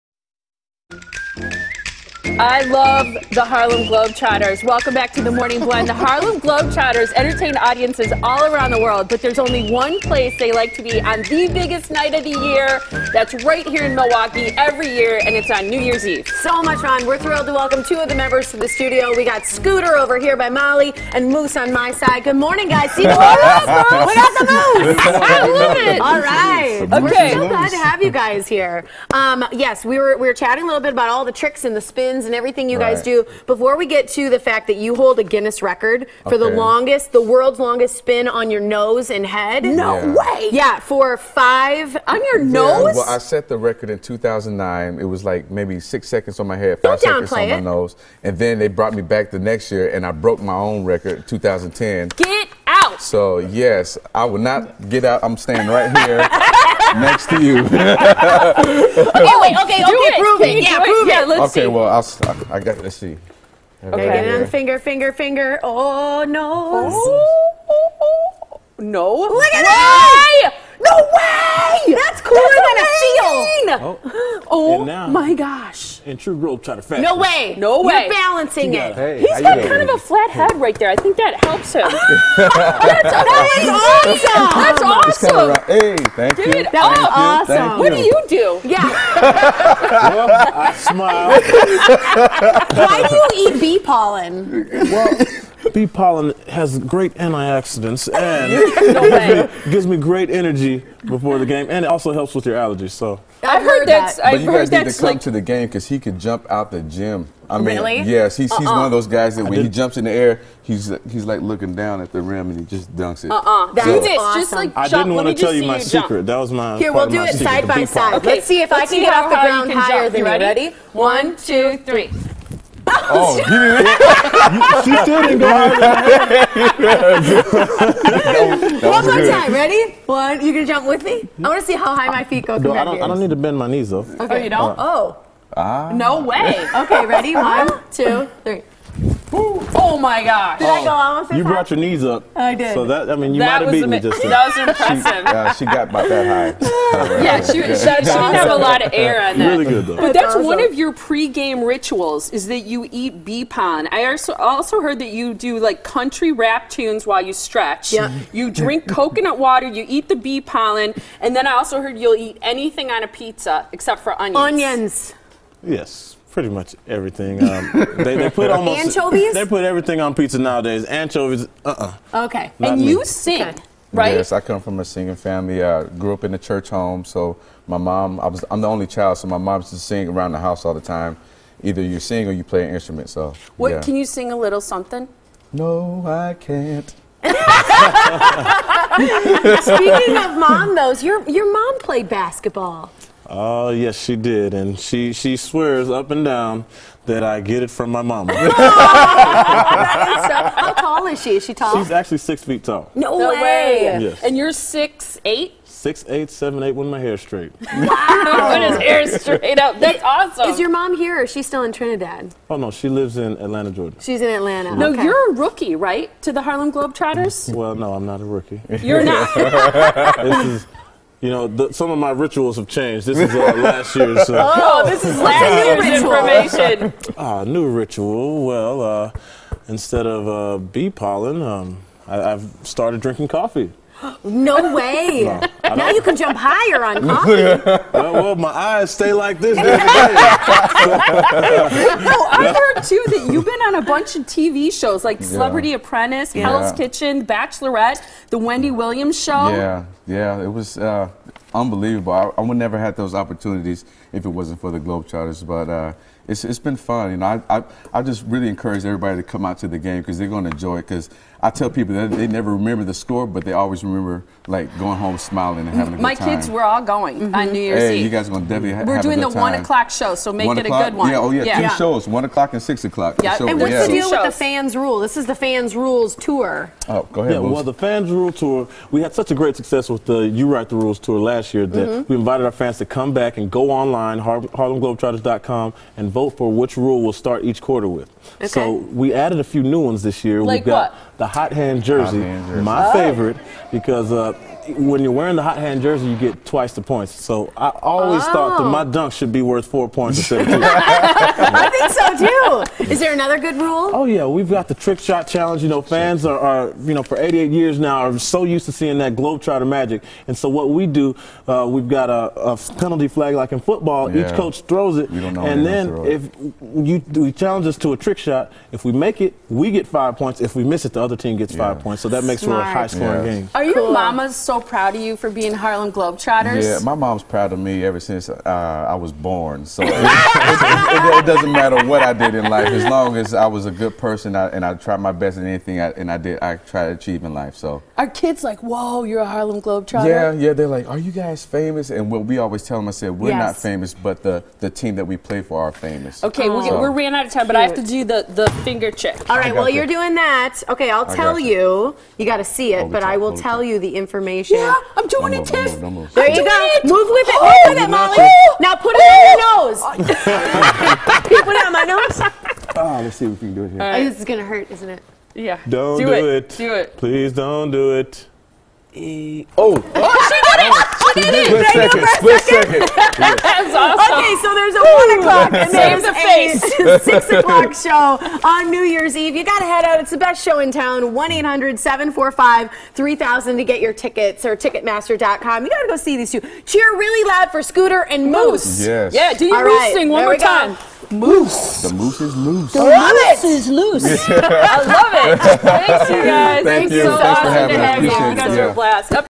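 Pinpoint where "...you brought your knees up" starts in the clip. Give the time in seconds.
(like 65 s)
141 s.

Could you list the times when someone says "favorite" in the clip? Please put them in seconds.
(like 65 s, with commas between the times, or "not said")
292 s.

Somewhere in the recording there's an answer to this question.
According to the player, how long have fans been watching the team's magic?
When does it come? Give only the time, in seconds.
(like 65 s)
307 s.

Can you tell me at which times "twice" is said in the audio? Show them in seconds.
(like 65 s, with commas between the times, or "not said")
296 s.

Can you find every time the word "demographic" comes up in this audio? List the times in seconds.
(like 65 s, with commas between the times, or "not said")
not said.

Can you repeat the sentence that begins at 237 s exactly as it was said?
well, well, my eyes stay like this.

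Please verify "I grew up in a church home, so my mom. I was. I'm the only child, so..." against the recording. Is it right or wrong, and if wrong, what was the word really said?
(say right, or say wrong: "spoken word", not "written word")
right.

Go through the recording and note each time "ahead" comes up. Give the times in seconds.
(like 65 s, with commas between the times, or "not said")
277 s.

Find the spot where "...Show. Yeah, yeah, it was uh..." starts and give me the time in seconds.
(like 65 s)
249 s.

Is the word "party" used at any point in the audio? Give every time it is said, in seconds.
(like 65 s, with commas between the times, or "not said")
not said.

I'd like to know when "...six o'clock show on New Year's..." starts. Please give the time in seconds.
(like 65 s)
377 s.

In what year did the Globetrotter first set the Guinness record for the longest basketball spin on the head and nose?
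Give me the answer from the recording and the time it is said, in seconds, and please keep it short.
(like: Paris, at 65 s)
2009, at 43 s.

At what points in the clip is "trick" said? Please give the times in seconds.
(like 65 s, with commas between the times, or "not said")
31 s, 304 s, 317 s.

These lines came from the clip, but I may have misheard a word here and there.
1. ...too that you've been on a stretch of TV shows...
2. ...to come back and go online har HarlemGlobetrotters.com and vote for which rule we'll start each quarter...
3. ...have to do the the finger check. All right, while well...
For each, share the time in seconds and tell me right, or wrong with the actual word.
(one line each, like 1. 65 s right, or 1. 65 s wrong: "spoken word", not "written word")
1. 242 s wrong: "bunch", not "stretch"
2. 282 s right
3. 347 s right.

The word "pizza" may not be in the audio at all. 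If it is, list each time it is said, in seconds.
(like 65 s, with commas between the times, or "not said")
163 s, 170 s.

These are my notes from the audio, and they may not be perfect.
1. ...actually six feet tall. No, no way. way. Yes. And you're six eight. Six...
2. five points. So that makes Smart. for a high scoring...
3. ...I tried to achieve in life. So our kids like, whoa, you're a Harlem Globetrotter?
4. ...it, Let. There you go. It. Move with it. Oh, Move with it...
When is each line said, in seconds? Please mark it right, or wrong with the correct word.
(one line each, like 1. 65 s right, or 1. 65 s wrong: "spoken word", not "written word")
1. 201 s right
2. 321 s right
3. 336 s right
4. 355 s wrong: "Tiff", not "Let".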